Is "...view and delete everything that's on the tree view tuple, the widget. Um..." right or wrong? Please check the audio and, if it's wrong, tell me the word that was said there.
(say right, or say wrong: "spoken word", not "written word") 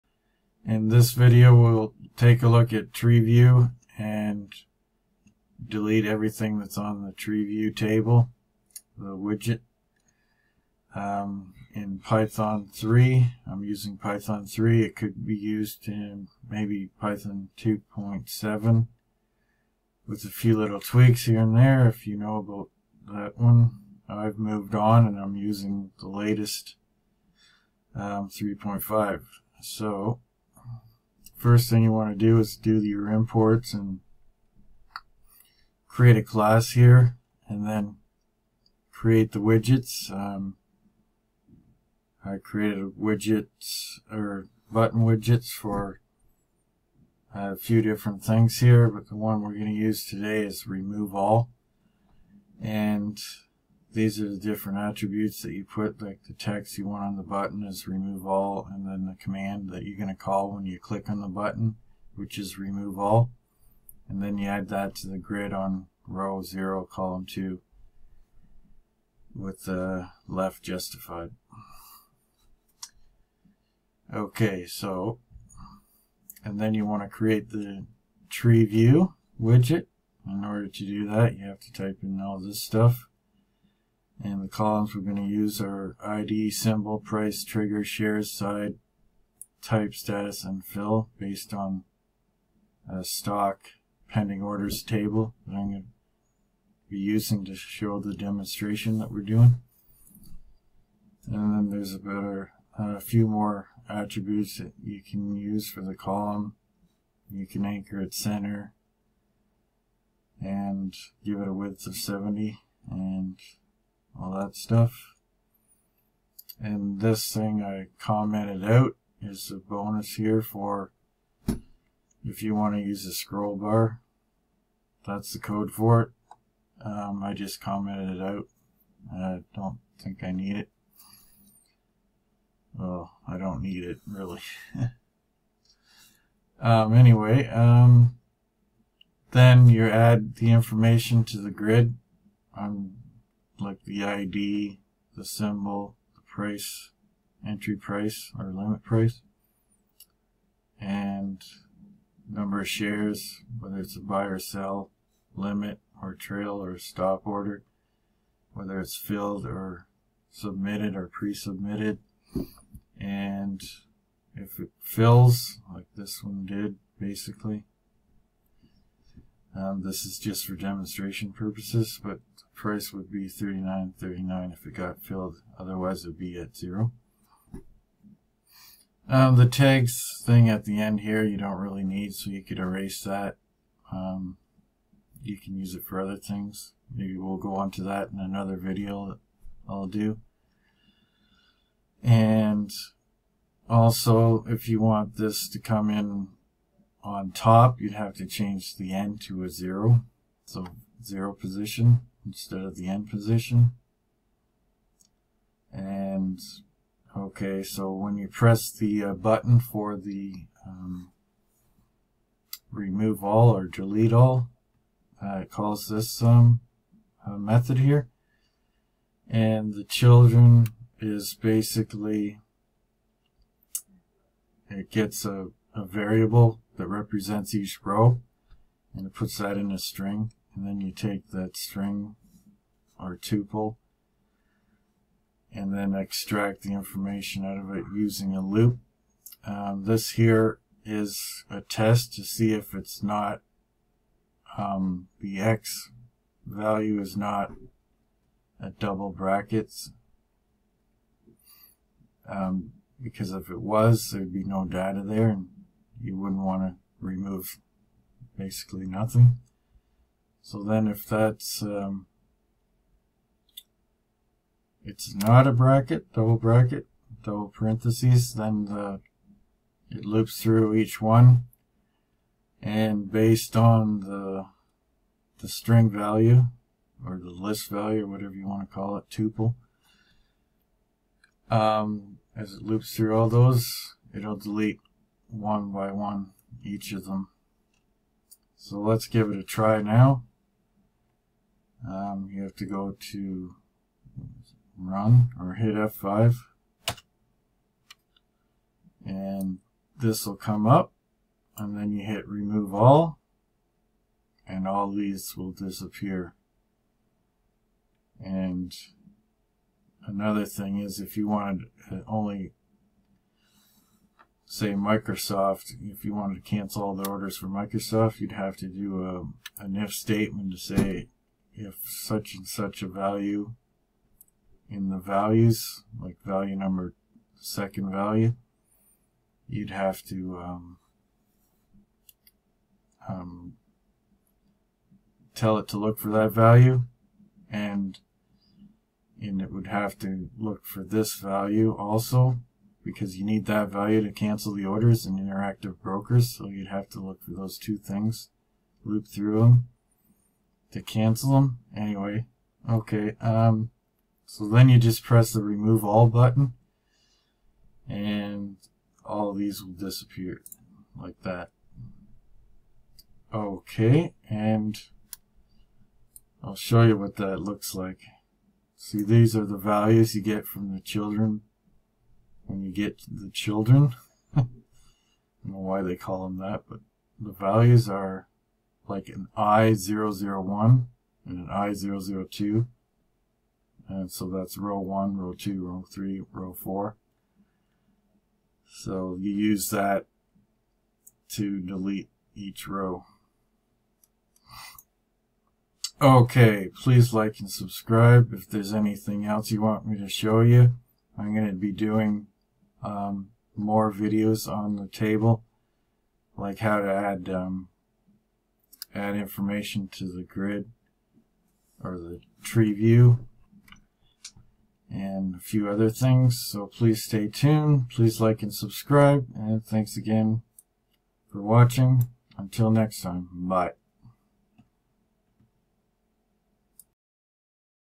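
wrong: "table", not "tuple".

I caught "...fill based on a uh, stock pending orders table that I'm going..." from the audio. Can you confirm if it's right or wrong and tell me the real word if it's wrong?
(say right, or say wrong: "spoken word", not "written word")
right.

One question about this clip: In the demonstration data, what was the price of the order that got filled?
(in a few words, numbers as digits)
39.39.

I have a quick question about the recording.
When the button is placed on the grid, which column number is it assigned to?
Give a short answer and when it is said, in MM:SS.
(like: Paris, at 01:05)
2, at 01:06.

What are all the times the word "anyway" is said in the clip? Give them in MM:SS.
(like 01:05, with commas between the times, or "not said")
02:16, 05:51.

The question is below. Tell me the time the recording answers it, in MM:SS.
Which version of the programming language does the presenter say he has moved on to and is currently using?
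00:28.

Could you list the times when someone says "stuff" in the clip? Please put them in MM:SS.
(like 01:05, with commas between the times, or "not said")
01:22, 01:54.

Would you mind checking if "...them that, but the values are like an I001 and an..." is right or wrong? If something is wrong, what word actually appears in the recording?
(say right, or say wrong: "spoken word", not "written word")
right.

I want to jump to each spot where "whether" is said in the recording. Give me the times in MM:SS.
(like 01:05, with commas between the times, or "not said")
02:33, 02:38.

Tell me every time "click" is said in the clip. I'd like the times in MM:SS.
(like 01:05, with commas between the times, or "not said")
01:00.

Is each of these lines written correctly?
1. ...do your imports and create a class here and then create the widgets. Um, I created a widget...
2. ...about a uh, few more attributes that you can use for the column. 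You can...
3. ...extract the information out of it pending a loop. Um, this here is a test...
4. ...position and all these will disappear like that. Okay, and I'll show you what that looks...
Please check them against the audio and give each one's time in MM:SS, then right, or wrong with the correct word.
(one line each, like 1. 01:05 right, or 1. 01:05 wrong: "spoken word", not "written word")
1. 00:32 right
2. 01:41 right
3. 03:55 wrong: "using", not "pending"
4. 05:56 wrong: "button", not "position".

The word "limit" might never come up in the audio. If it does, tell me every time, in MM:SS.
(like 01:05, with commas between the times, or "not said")
02:28, 02:35.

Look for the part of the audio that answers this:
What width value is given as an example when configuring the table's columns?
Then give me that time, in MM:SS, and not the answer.
01:51.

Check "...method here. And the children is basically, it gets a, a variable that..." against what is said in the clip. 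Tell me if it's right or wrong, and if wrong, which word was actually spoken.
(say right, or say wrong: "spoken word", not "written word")
right.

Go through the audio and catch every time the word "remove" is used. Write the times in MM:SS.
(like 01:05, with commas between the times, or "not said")
00:50, 00:57, 01:02, 03:32, 04:16, 05:02, 05:55.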